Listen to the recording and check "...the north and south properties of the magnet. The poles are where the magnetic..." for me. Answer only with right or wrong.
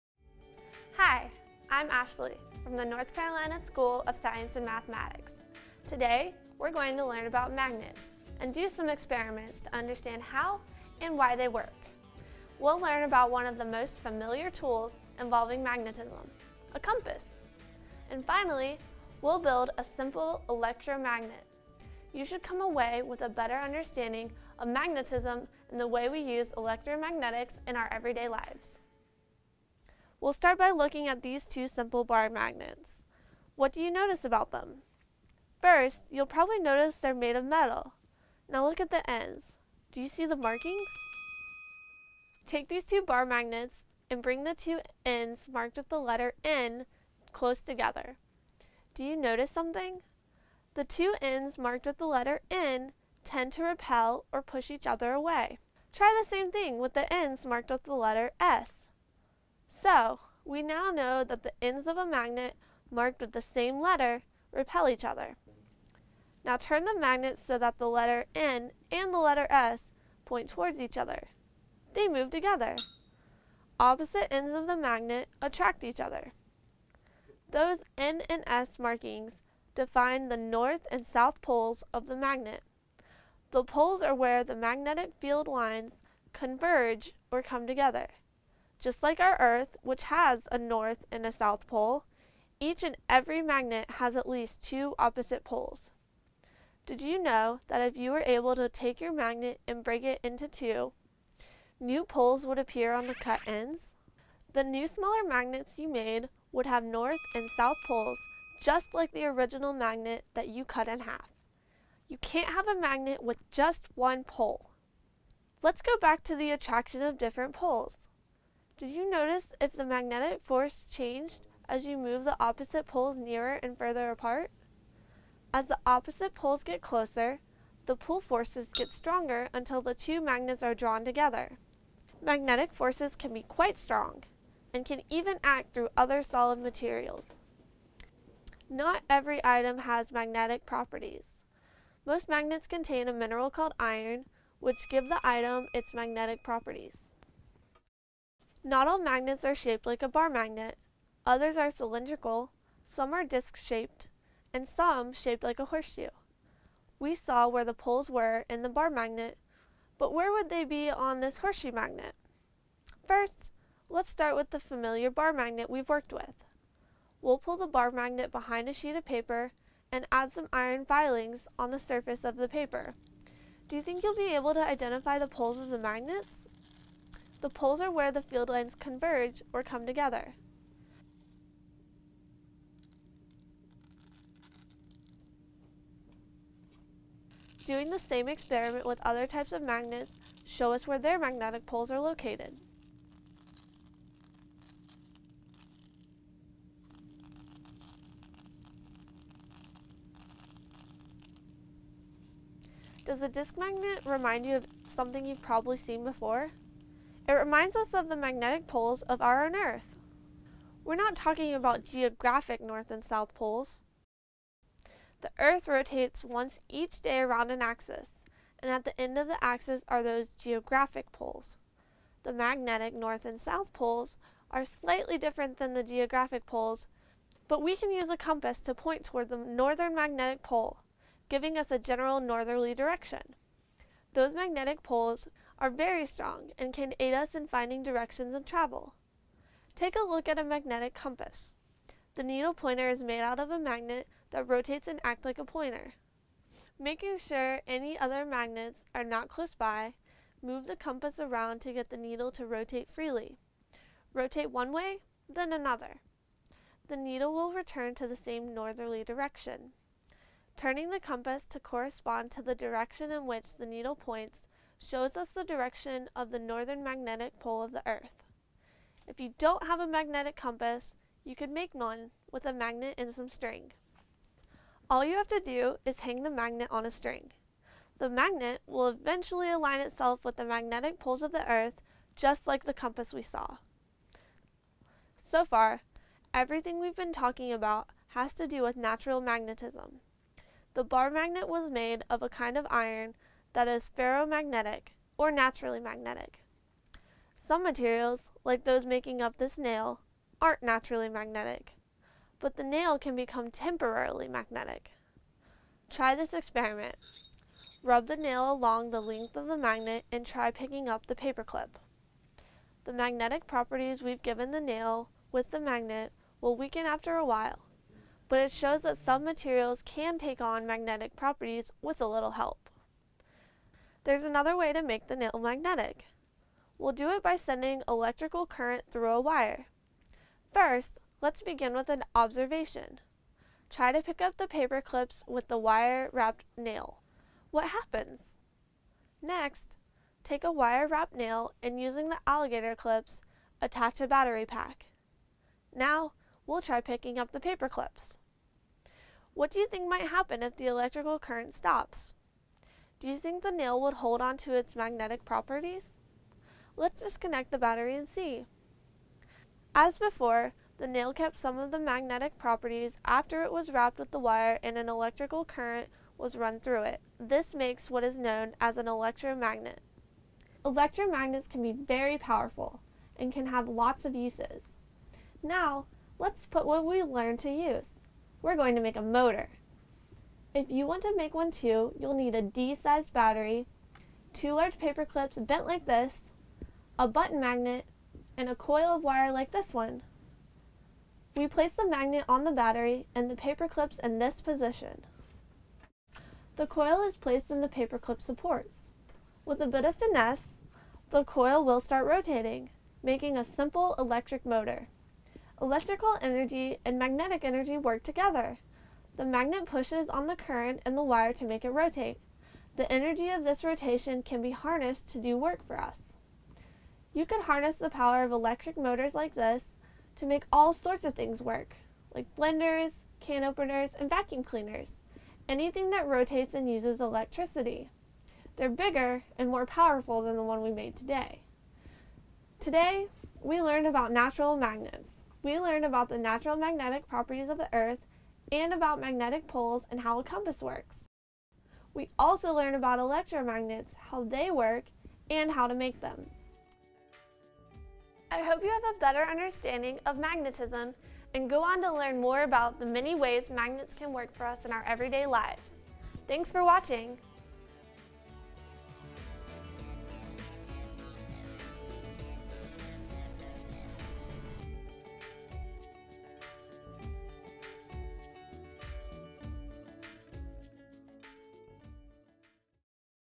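wrong.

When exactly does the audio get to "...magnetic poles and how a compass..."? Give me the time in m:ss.
7:18.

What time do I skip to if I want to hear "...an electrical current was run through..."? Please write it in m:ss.
6:04.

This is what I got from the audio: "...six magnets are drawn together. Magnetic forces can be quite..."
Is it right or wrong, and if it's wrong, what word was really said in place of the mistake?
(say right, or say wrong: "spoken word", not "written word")
wrong: "two", not "six".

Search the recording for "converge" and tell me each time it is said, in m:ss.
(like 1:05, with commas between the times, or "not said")
1:26, 2:58.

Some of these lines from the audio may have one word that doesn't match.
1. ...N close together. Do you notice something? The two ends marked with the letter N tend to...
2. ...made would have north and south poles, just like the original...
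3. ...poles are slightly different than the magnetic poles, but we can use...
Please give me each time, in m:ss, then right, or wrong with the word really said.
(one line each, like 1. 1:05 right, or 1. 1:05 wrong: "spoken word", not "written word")
1. 0:46 right
2. 1:45 right
3. 3:43 wrong: "geographic", not "magnetic".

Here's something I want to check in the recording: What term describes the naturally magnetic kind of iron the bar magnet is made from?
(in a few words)
ferromagnetic.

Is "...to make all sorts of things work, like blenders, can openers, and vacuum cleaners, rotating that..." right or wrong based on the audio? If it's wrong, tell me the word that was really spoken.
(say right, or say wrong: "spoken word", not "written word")
wrong: "anything", not "rotating".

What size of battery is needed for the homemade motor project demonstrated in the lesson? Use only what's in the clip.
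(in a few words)
D-sized.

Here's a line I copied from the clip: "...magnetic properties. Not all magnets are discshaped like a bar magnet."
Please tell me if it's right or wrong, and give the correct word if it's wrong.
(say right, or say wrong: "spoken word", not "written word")
wrong: "shaped", not "discshaped".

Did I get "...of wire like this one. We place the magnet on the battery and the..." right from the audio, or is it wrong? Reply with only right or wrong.
right.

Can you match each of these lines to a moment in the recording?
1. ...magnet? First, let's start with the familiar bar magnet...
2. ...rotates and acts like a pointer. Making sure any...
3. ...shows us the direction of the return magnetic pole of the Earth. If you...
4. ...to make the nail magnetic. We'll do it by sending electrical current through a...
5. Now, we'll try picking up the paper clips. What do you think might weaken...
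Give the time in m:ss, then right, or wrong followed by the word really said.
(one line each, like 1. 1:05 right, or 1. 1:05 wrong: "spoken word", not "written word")
1. 2:41 right
2. 4:04 right
3. 4:24 wrong: "northern", not "return"
4. 5:24 right
5. 5:45 wrong: "happen", not "weaken".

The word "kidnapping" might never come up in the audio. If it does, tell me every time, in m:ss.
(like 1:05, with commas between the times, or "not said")
not said.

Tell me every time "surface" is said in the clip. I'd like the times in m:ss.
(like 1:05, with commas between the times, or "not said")
2:51.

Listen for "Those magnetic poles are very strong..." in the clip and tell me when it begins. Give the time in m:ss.
3:54.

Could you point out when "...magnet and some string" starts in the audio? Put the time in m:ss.
4:32.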